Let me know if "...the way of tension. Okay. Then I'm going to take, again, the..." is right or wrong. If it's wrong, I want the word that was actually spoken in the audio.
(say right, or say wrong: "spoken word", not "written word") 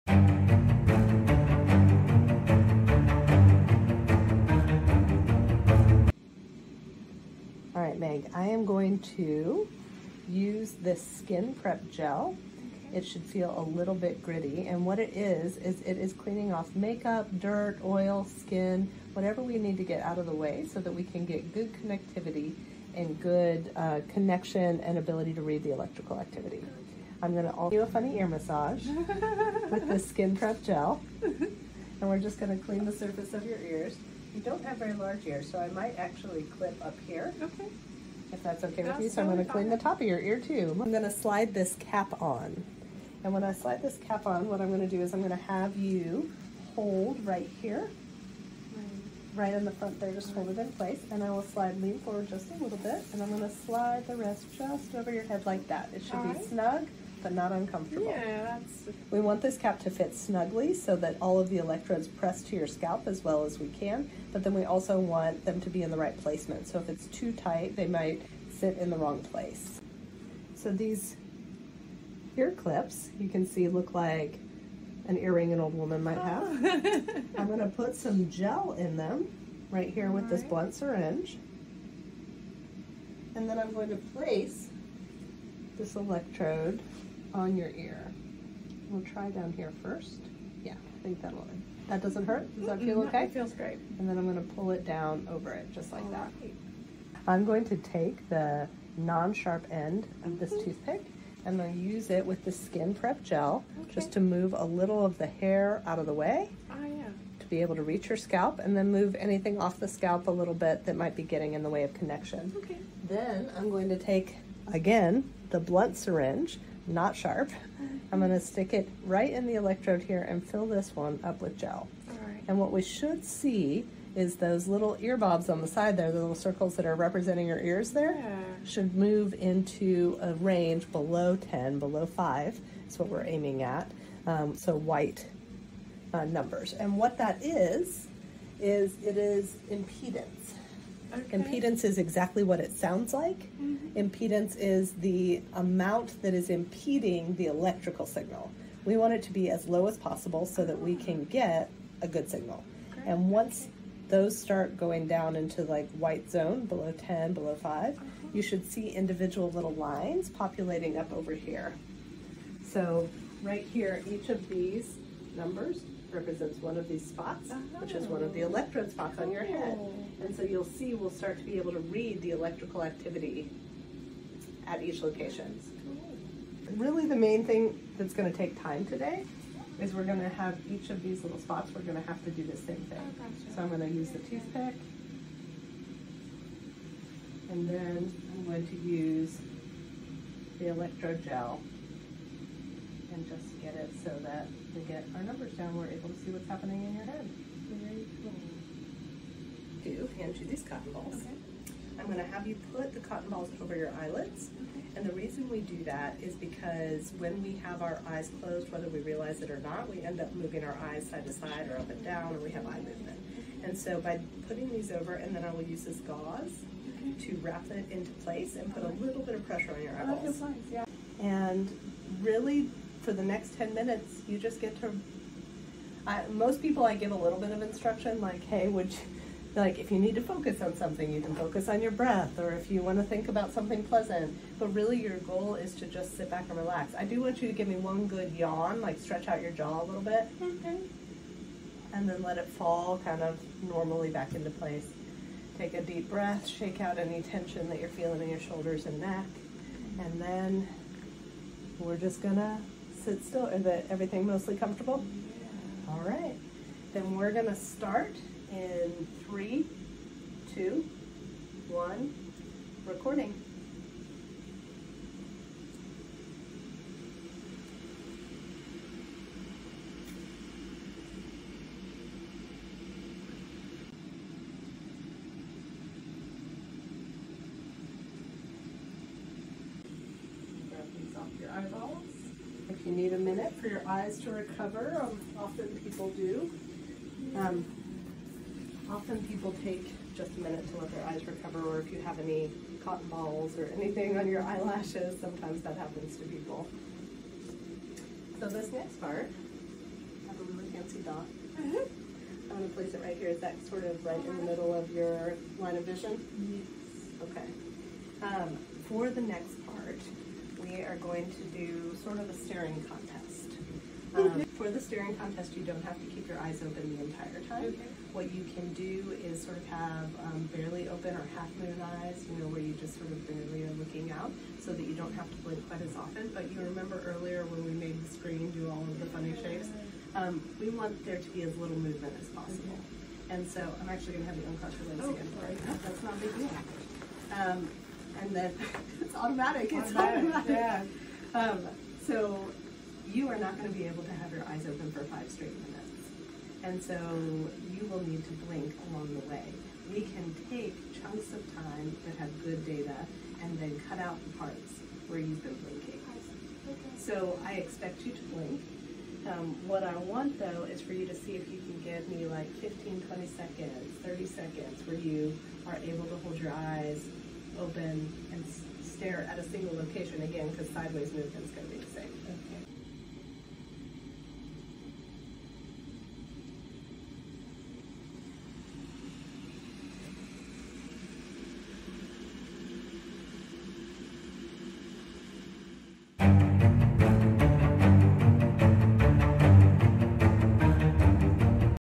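wrong: "connection", not "tension".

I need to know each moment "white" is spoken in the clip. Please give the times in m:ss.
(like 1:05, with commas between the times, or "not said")
2:14, 2:36.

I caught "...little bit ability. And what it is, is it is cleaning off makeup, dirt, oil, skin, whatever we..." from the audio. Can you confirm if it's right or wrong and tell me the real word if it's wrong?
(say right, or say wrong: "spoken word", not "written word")
wrong: "gritty", not "ability".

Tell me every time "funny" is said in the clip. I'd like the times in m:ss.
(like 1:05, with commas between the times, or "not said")
0:27, 5:29.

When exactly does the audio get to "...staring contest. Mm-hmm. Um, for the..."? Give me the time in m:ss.
5:12.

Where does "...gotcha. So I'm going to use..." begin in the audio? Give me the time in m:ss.
3:03.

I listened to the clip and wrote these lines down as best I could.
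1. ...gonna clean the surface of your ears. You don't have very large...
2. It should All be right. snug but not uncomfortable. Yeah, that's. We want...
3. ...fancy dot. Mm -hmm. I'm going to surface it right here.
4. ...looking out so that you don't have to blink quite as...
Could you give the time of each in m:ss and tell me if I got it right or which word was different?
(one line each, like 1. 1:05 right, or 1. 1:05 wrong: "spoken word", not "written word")
1. 0:32 right
2. 0:55 right
3. 5:00 wrong: "place", not "surface"
4. 5:23 right.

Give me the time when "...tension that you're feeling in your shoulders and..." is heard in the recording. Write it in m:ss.
4:07.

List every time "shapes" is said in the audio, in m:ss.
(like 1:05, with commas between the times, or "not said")
5:29.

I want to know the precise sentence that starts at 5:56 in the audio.
So I expect you to blink.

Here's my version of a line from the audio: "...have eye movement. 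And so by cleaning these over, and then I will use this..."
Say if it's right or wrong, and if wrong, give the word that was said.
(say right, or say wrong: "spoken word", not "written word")
wrong: "putting", not "cleaning".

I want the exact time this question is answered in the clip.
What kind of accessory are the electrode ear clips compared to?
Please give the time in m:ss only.
1:15.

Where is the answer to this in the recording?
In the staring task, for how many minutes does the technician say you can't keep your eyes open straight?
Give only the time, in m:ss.
5:45.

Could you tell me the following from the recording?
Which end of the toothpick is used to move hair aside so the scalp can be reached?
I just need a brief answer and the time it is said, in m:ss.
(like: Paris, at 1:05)
non-sharp end, at 1:38.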